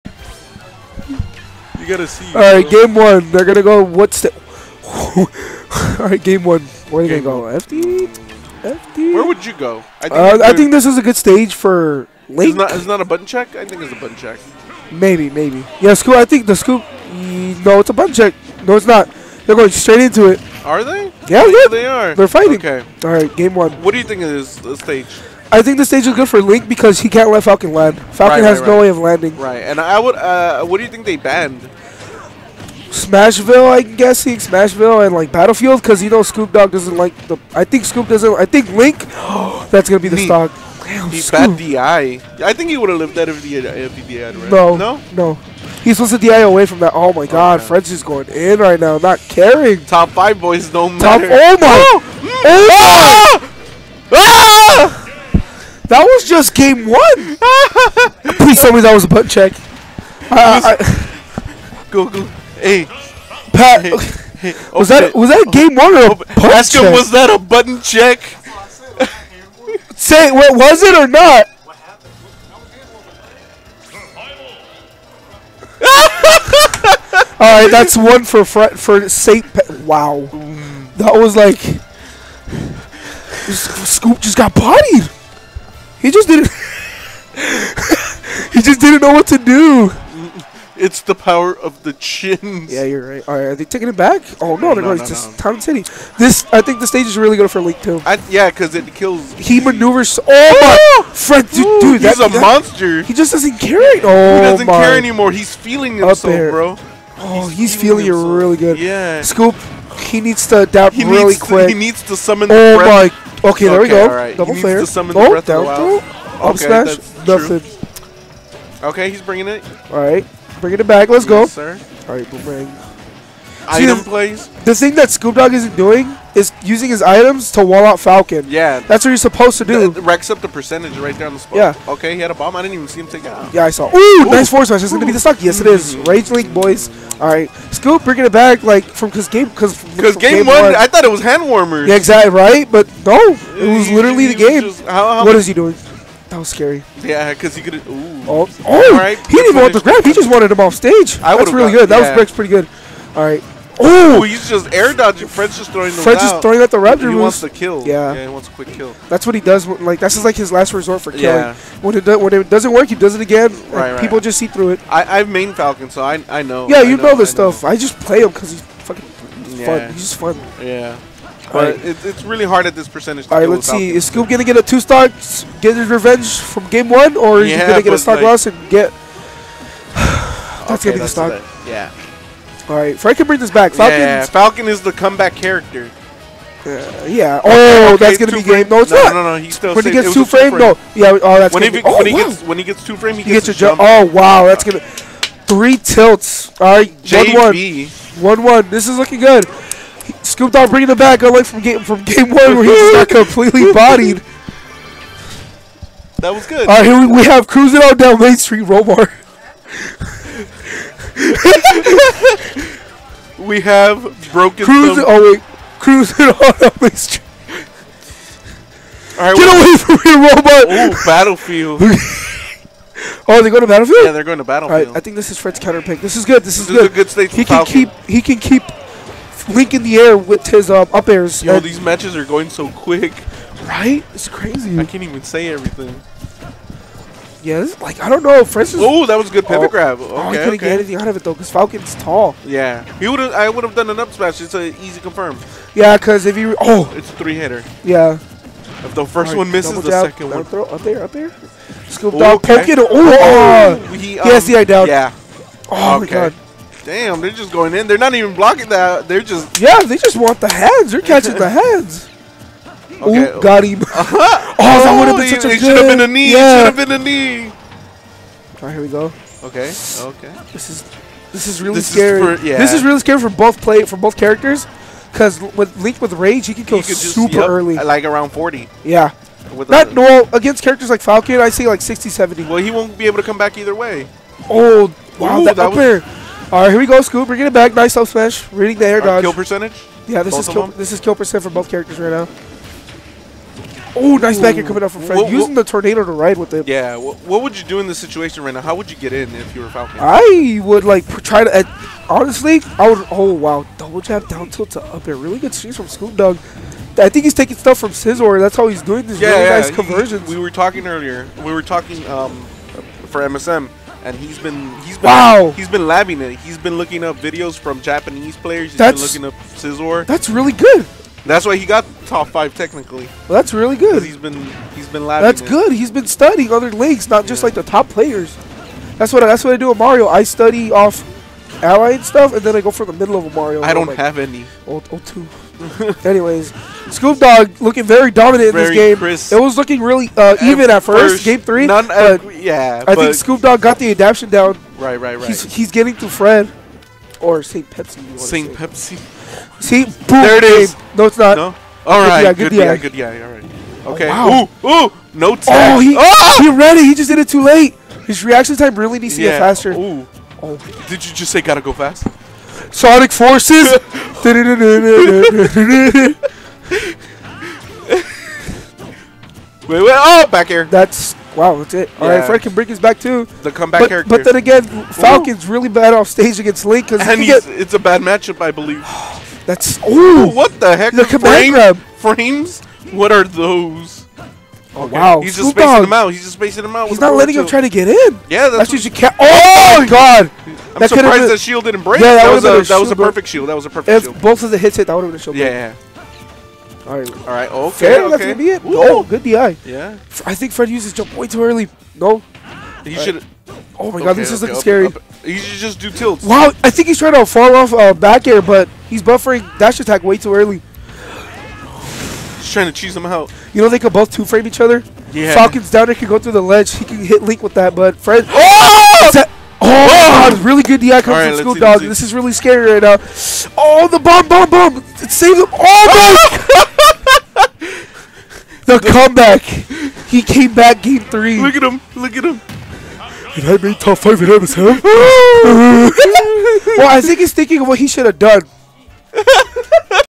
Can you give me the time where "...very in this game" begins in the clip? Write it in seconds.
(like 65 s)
338 s.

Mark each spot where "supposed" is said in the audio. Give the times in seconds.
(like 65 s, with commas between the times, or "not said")
45 s, 129 s.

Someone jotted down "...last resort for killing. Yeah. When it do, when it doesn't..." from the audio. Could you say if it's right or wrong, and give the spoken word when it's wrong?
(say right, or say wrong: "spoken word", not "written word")
right.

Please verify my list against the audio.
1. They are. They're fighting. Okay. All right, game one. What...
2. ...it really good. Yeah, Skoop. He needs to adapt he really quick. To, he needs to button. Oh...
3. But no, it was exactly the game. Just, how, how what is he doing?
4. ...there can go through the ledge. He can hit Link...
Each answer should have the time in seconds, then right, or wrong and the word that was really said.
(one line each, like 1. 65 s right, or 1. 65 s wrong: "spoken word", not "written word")
1. 21 s right
2. 108 s wrong: "summon", not "button"
3. 142 s wrong: "literally", not "exactly"
4. 415 s right.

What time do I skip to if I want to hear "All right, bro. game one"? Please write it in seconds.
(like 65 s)
2 s.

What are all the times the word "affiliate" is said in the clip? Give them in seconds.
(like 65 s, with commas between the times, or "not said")
not said.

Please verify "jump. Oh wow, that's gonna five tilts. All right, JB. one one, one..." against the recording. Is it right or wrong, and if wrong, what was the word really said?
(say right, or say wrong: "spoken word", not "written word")
wrong: "three", not "five".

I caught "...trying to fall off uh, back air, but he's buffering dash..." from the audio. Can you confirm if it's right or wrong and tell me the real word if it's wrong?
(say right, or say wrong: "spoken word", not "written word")
right.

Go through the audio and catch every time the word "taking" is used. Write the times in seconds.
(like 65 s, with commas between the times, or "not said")
93 s, 307 s.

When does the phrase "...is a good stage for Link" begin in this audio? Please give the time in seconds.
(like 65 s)
10 s.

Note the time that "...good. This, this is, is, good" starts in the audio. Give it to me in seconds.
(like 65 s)
226 s.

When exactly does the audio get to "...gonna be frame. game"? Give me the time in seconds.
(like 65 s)
188 s.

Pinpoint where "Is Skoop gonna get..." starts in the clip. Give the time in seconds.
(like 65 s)
173 s.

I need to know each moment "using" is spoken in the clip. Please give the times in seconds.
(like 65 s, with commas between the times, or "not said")
126 s, 295 s.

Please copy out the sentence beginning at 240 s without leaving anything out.
get anything out of it though, because Falcon's tall.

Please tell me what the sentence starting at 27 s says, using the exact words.
Falcon right, has right, no right.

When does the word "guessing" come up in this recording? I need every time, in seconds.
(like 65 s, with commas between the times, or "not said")
33 s.